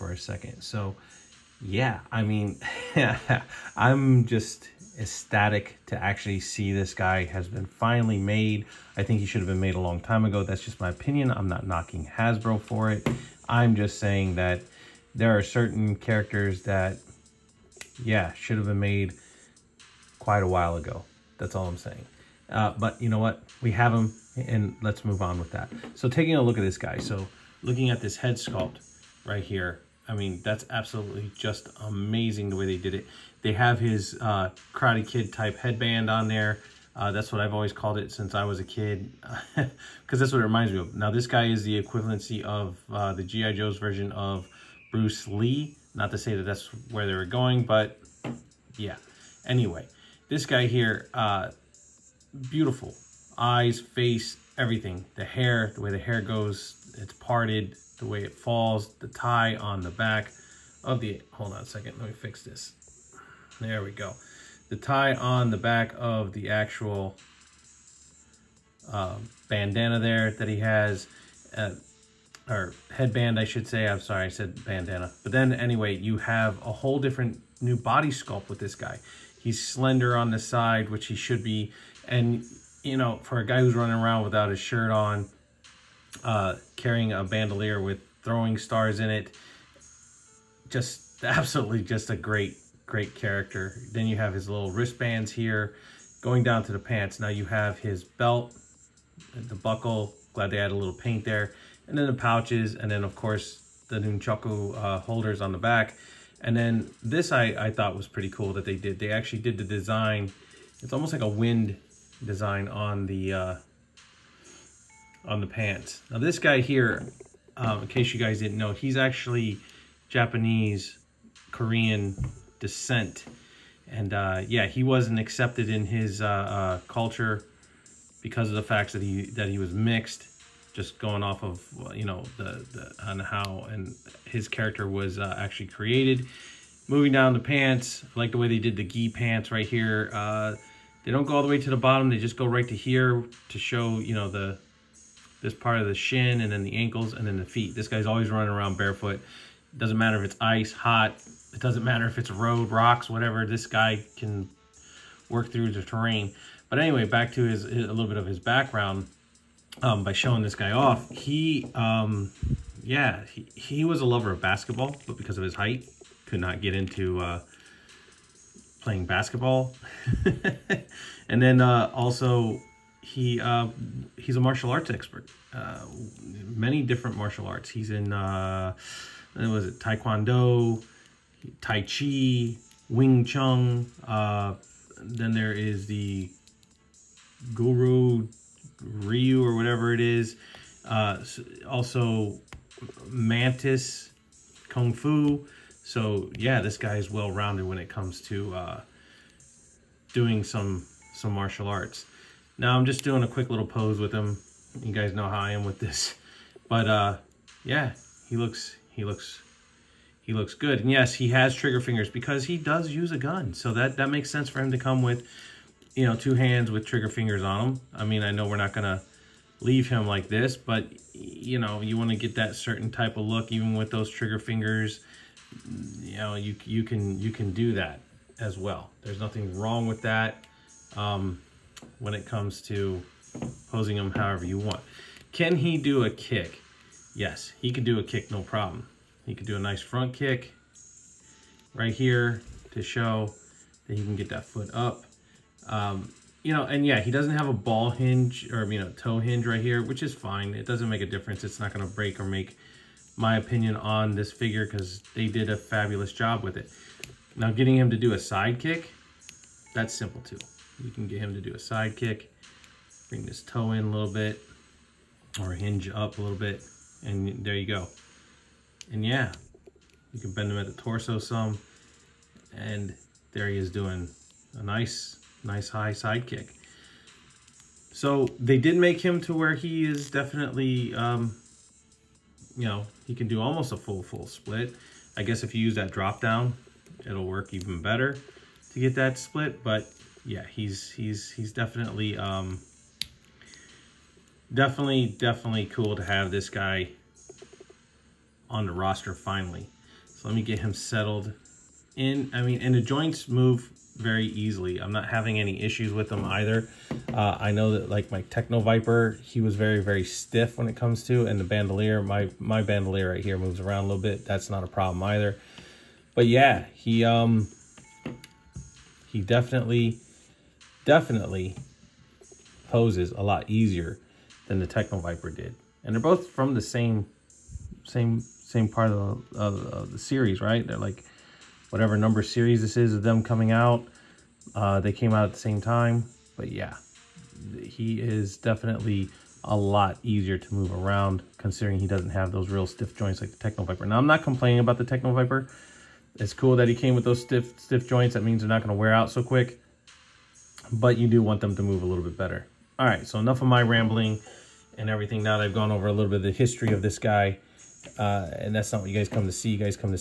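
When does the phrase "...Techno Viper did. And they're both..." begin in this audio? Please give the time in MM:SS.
05:24.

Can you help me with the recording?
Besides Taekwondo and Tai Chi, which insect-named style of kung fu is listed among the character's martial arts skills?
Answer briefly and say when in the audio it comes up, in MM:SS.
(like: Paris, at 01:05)
Mantis Kung Fu, at 03:13.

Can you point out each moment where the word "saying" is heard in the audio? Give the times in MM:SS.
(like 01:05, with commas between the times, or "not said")
00:13, 00:21.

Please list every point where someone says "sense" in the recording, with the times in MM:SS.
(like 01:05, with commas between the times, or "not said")
03:34.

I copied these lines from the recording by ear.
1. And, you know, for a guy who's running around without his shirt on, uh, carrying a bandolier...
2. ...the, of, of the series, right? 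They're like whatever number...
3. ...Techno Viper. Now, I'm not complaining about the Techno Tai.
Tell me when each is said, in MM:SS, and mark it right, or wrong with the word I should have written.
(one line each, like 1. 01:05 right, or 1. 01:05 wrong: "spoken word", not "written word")
1. 01:22 right
2. 05:29 right
3. 05:43 wrong: "Viper", not "Tai".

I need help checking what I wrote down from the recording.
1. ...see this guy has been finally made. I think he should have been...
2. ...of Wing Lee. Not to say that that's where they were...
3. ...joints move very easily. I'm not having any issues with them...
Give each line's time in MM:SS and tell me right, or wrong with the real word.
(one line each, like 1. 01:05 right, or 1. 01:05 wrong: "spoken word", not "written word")
1. 00:06 right
2. 00:44 wrong: "Bruce", not "Wing"
3. 05:02 right.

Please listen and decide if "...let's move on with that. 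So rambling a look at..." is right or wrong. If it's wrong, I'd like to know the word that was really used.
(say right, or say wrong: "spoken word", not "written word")
wrong: "taking", not "rambling".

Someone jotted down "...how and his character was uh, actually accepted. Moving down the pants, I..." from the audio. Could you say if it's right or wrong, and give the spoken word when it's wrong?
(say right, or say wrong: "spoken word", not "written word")
wrong: "created", not "accepted".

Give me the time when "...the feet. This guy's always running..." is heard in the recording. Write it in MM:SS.
02:27.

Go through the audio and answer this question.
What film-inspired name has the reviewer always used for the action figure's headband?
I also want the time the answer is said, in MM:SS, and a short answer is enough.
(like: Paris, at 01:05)
Karate Kid, at 00:34.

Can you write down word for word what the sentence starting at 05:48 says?
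That means they're not going to wear out so quick, but you do want them to move a little bit better.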